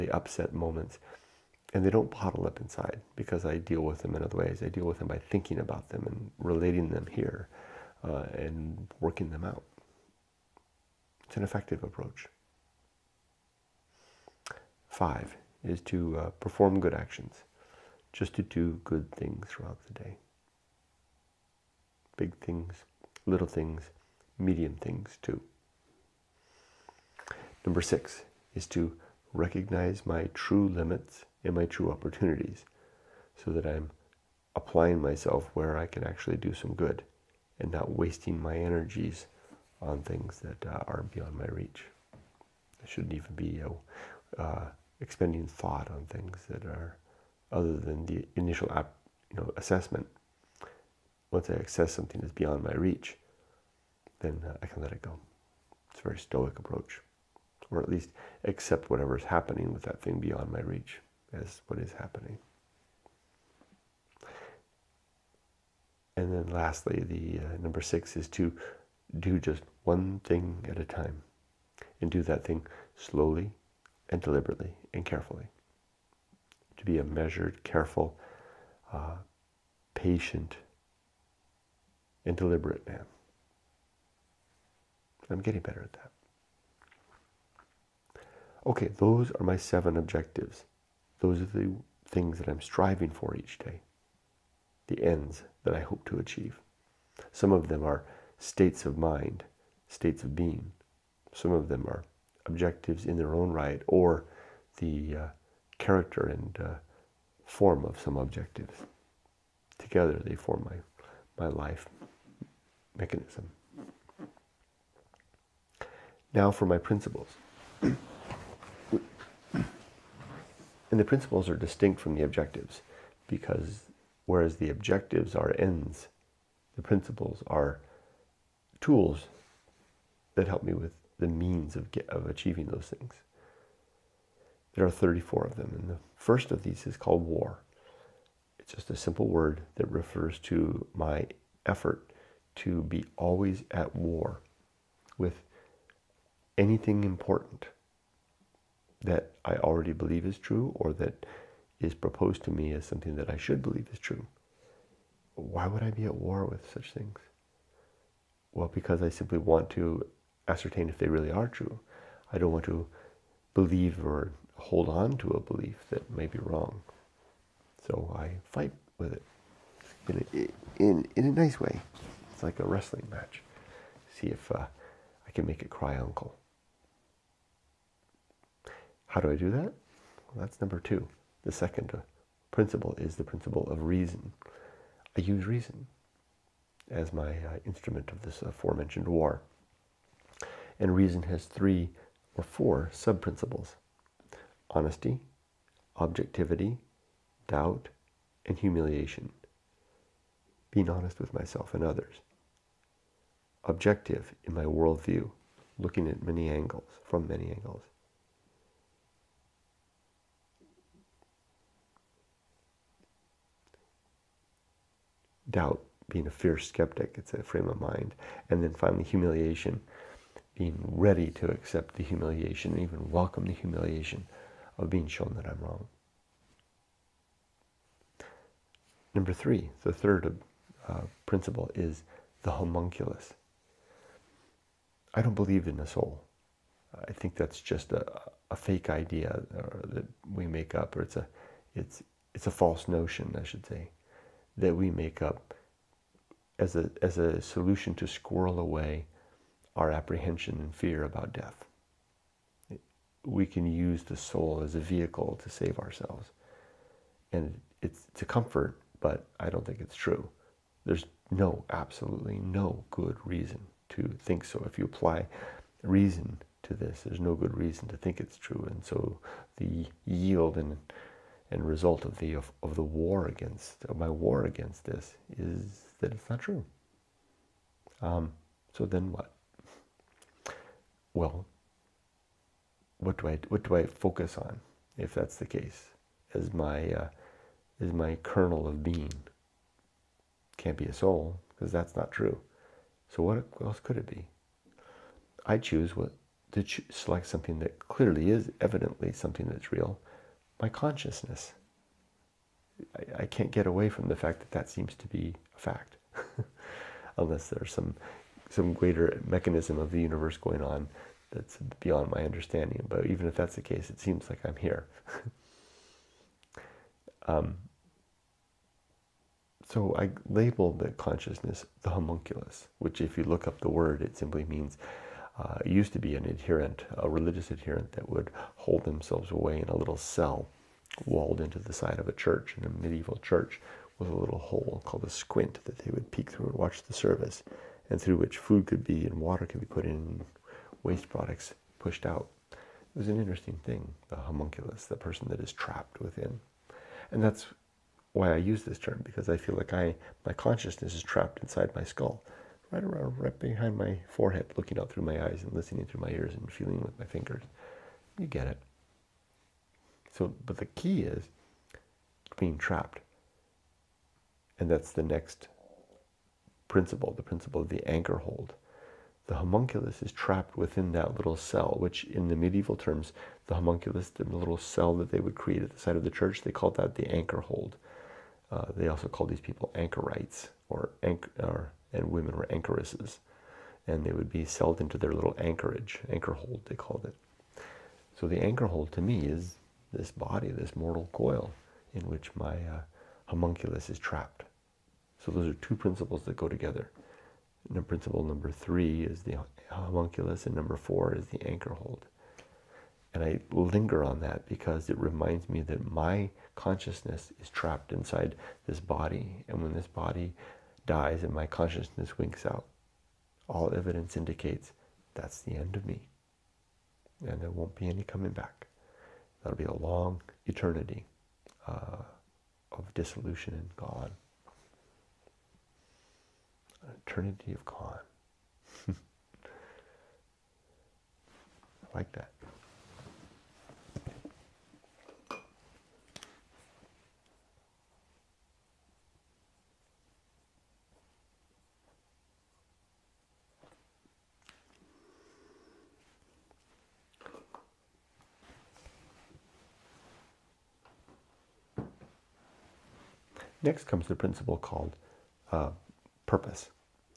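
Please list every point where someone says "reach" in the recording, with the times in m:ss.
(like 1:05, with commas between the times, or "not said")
0:41, 0:52, 1:00.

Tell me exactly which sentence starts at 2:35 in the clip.
Why would I be at war with such things?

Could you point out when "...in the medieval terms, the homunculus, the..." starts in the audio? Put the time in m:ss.
6:12.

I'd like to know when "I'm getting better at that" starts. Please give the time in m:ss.
1:25.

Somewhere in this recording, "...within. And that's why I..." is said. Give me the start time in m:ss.
5:45.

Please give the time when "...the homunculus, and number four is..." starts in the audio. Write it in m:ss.
6:39.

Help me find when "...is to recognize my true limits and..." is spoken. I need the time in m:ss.
0:28.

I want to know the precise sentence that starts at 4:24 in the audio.
If you apply reason to this, there's no good reason to think it's true.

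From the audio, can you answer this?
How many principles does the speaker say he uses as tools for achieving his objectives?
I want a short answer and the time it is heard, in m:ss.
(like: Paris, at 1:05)
34, at 2:14.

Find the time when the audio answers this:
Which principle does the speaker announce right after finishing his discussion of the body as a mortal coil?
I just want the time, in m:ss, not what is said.
7:36.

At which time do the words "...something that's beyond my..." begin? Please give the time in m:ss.
0:51.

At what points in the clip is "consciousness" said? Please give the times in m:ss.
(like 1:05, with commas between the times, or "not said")
5:00, 5:20, 5:50, 6:46, 6:51.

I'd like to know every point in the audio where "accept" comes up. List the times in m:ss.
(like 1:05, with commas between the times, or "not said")
0:58, 3:41.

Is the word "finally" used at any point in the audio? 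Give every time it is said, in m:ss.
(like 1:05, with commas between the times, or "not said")
3:38.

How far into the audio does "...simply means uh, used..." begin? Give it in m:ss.
5:24.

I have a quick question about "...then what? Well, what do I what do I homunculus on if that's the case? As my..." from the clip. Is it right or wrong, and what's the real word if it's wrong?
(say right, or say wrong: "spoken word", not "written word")
wrong: "focus", not "homunculus".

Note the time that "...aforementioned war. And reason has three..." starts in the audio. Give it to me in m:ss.
3:08.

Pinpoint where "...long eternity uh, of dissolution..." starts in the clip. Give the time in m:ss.
6:59.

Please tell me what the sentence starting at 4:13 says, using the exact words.
We can use the soul as a vehicle to save ourselves.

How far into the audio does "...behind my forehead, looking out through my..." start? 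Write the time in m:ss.
5:53.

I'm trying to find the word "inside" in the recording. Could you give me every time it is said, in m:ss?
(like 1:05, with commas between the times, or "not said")
0:02, 5:51, 6:47.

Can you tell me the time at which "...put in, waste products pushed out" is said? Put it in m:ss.
5:39.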